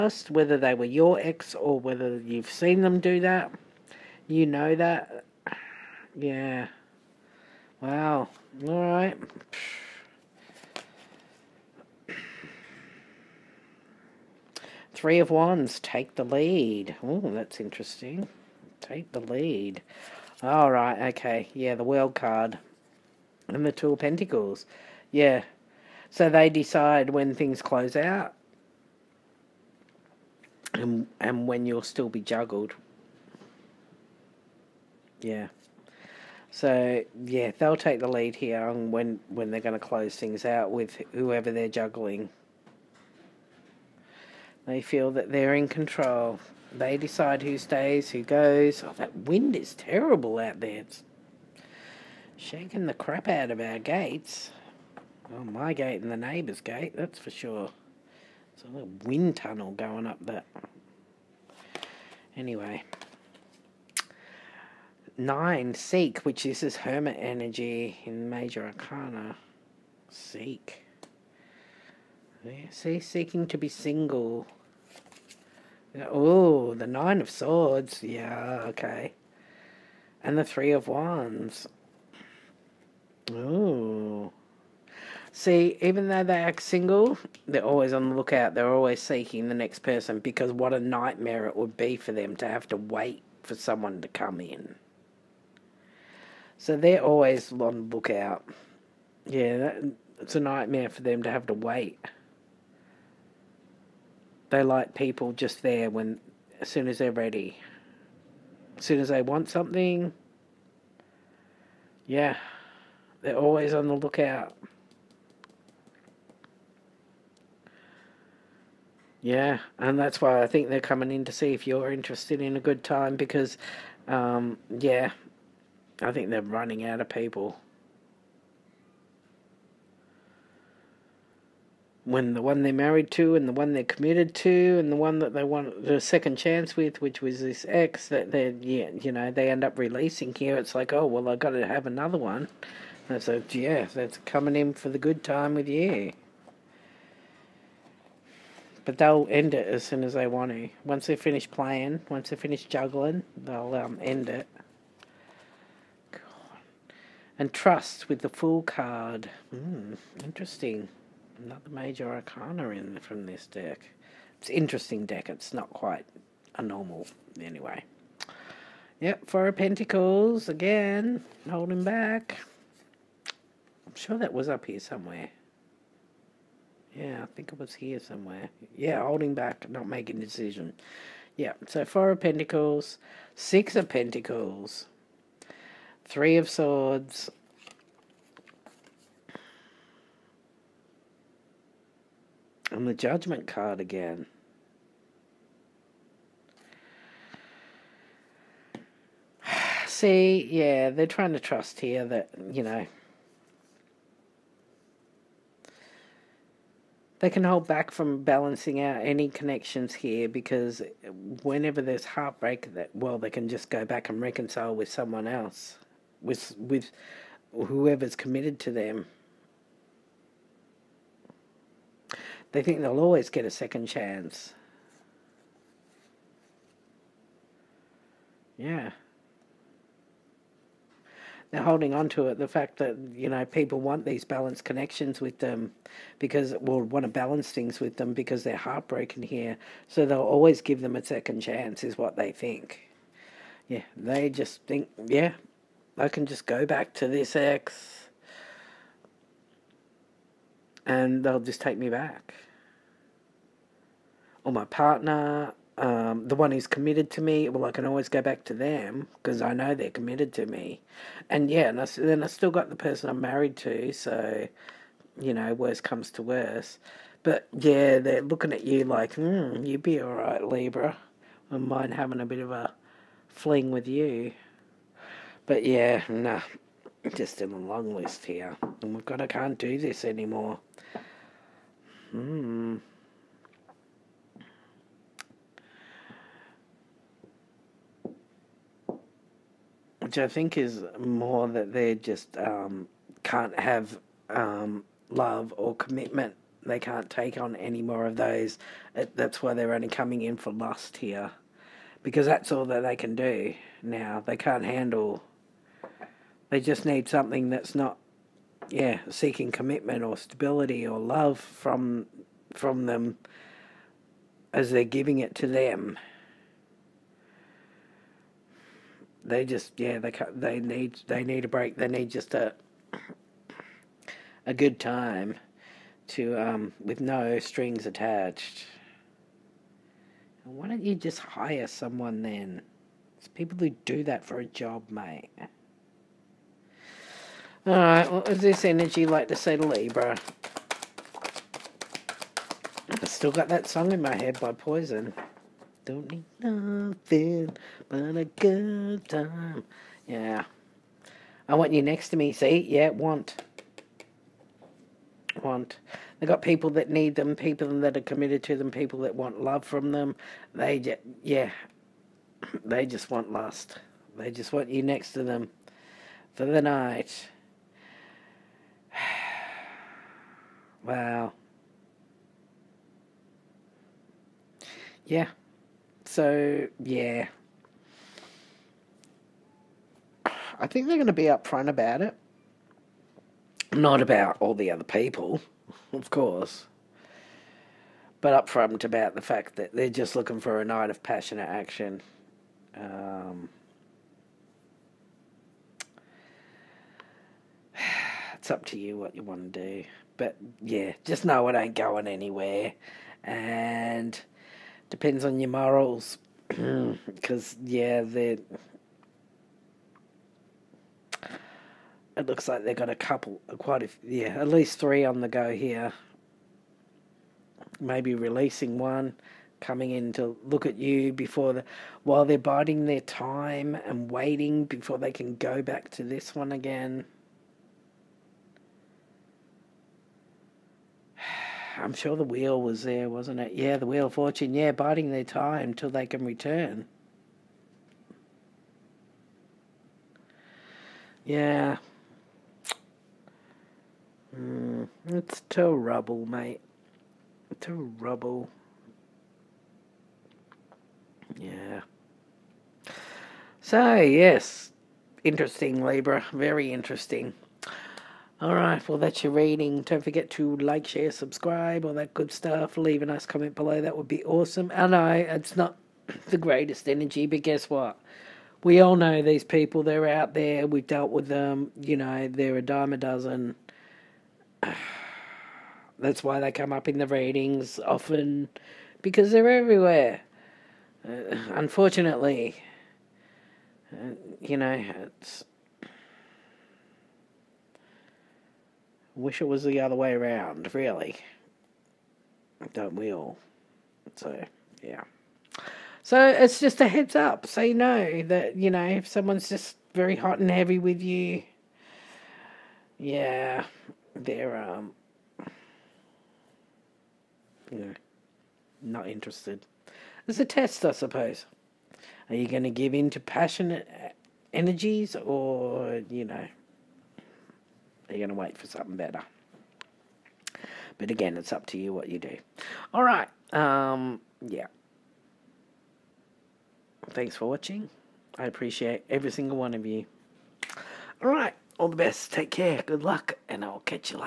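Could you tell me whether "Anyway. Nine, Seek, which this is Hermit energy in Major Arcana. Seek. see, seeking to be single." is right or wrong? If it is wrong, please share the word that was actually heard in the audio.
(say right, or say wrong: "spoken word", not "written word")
right.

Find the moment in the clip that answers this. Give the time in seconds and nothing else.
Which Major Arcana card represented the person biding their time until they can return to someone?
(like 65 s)
433 s.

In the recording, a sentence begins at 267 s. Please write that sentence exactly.
But yeah, they're looking at you like, hmm, you'd be alright, Libra.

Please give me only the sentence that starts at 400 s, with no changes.
But yeah, just know it ain't going anywhere.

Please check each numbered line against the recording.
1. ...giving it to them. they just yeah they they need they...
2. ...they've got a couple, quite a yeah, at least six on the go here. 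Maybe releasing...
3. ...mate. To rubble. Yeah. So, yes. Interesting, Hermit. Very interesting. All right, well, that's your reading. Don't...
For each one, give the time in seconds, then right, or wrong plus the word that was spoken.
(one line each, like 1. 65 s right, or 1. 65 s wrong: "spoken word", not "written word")
1. 314 s right
2. 412 s wrong: "three", not "six"
3. 446 s wrong: "Libra", not "Hermit".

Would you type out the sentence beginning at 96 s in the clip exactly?
So they're always on the lookout.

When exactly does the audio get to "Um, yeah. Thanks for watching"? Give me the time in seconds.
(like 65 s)
523 s.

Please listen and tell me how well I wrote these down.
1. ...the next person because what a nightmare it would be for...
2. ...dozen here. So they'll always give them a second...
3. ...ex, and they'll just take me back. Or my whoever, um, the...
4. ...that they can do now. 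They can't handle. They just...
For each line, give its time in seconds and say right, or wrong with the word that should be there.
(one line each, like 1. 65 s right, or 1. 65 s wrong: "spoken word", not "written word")
1. 89 s right
2. 238 s wrong: "heartbroken", not "dozen"
3. 247 s wrong: "partner", not "whoever"
4. 302 s right.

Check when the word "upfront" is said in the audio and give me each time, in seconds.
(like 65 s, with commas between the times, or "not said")
381 s, 388 s.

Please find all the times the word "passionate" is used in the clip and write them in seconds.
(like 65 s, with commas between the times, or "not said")
391 s, 513 s.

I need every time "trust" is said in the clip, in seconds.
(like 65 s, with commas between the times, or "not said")
157 s, 201 s.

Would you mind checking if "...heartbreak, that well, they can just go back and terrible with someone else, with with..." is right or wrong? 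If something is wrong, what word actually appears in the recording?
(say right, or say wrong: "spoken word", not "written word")
wrong: "reconcile", not "terrible".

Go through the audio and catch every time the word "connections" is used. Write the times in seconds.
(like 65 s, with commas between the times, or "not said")
209 s, 234 s.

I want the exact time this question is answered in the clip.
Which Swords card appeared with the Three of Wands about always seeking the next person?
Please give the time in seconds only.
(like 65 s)
76 s.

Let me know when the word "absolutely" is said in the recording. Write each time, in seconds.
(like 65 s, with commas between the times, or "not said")
not said.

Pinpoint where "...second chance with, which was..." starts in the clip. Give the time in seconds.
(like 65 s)
136 s.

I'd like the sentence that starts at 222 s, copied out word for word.
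They think they'll always get a second chance.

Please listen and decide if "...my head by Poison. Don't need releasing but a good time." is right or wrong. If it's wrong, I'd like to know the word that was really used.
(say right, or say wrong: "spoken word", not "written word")
wrong: "nothing", not "releasing".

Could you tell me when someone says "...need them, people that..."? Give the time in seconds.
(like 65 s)
356 s.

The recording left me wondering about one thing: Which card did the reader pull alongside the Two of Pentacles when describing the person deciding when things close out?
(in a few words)
The World.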